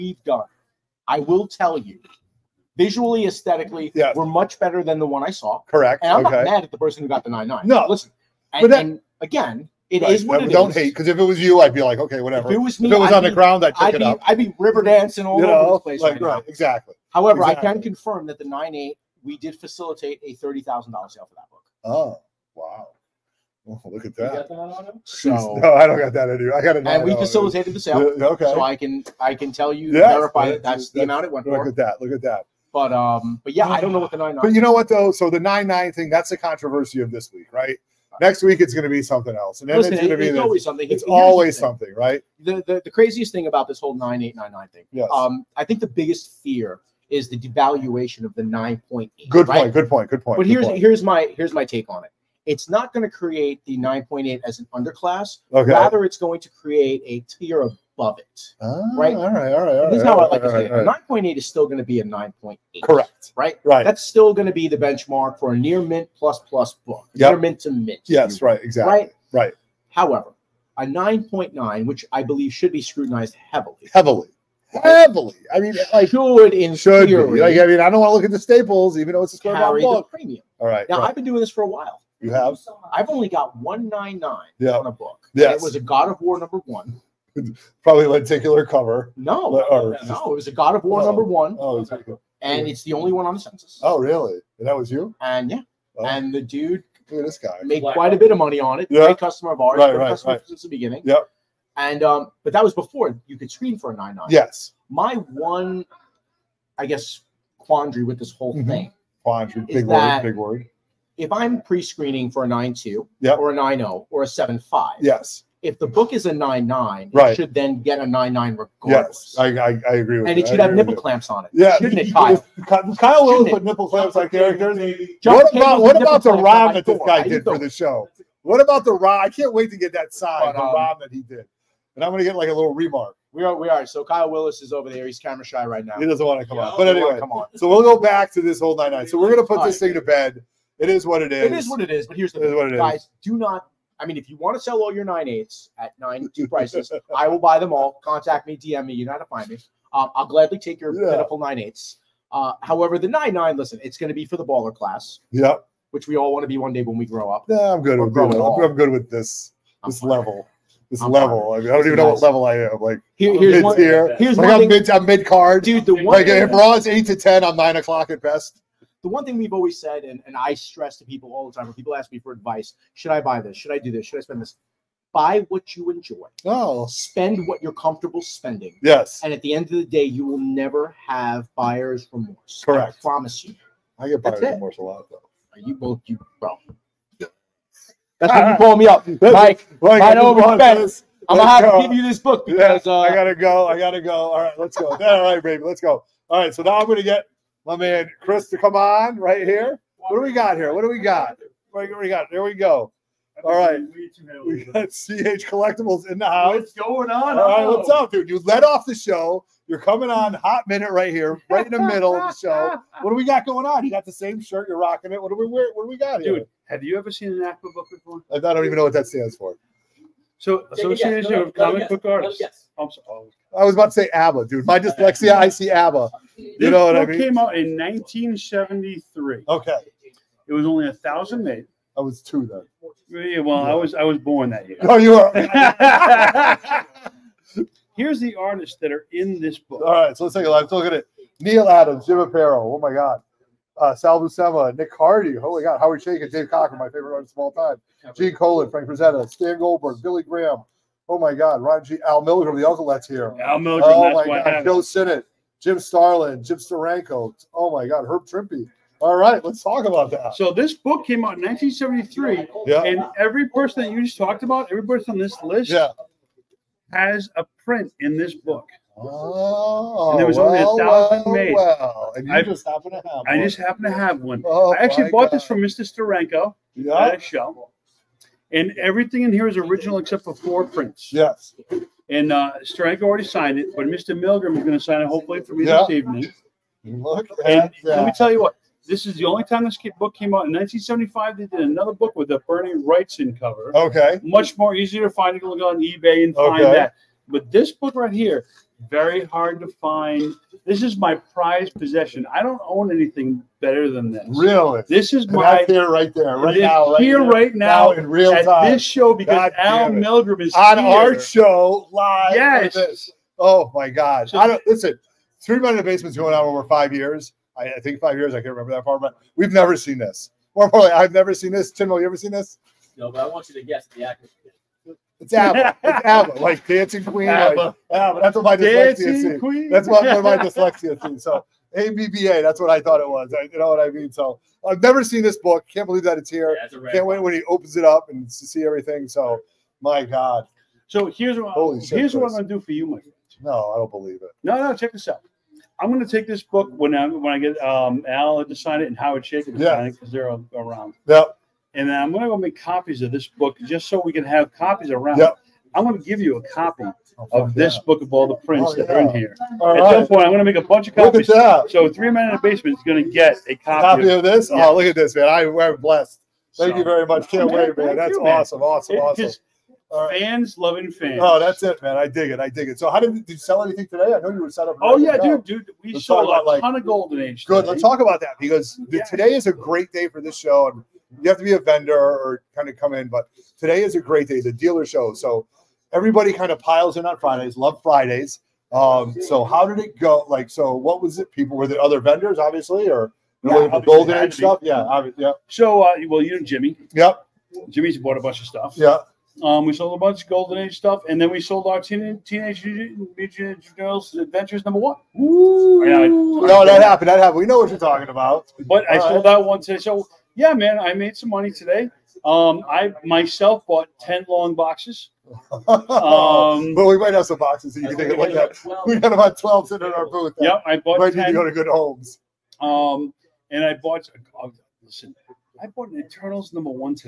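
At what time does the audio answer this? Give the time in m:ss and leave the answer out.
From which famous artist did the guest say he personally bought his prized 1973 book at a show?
4:35.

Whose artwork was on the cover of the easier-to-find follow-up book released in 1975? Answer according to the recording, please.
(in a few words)
Bernie Wrightson.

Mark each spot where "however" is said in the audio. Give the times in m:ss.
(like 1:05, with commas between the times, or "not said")
0:17, 1:09, 2:32.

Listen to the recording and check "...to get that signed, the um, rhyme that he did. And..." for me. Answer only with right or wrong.
right.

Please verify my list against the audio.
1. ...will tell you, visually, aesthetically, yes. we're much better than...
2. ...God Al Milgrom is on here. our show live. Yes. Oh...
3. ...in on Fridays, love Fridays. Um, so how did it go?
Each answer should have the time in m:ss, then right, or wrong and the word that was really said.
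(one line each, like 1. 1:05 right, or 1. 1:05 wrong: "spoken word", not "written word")
1. 0:01 right
2. 5:09 right
3. 6:26 right.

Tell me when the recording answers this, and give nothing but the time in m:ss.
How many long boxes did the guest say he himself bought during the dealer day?
6:53.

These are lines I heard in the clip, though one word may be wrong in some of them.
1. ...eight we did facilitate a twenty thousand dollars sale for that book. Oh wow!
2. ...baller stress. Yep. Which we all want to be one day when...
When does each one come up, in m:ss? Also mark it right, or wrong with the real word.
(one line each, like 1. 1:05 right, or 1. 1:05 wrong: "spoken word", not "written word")
1. 0:18 wrong: "thirty", not "twenty"
2. 2:34 wrong: "class", not "stress".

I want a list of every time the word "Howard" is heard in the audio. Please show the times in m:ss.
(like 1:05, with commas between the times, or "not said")
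4:05, 5:48.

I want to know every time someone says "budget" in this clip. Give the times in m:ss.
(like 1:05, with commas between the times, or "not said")
not said.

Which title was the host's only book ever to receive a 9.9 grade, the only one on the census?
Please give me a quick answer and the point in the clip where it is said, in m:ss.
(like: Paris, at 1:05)
God of War #1, at 1:25.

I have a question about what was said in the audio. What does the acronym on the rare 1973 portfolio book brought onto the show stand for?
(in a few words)
Association of Comic Book Artists.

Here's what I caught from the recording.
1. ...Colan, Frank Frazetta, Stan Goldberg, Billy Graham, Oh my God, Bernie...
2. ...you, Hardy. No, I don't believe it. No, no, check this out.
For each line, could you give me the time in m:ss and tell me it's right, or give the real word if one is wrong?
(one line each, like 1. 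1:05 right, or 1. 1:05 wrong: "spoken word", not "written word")
1. 4:08 wrong: "Ron", not "Bernie"
2. 5:42 wrong: "Mike", not "Hardy".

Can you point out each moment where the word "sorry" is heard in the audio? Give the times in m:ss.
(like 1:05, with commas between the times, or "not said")
3:42.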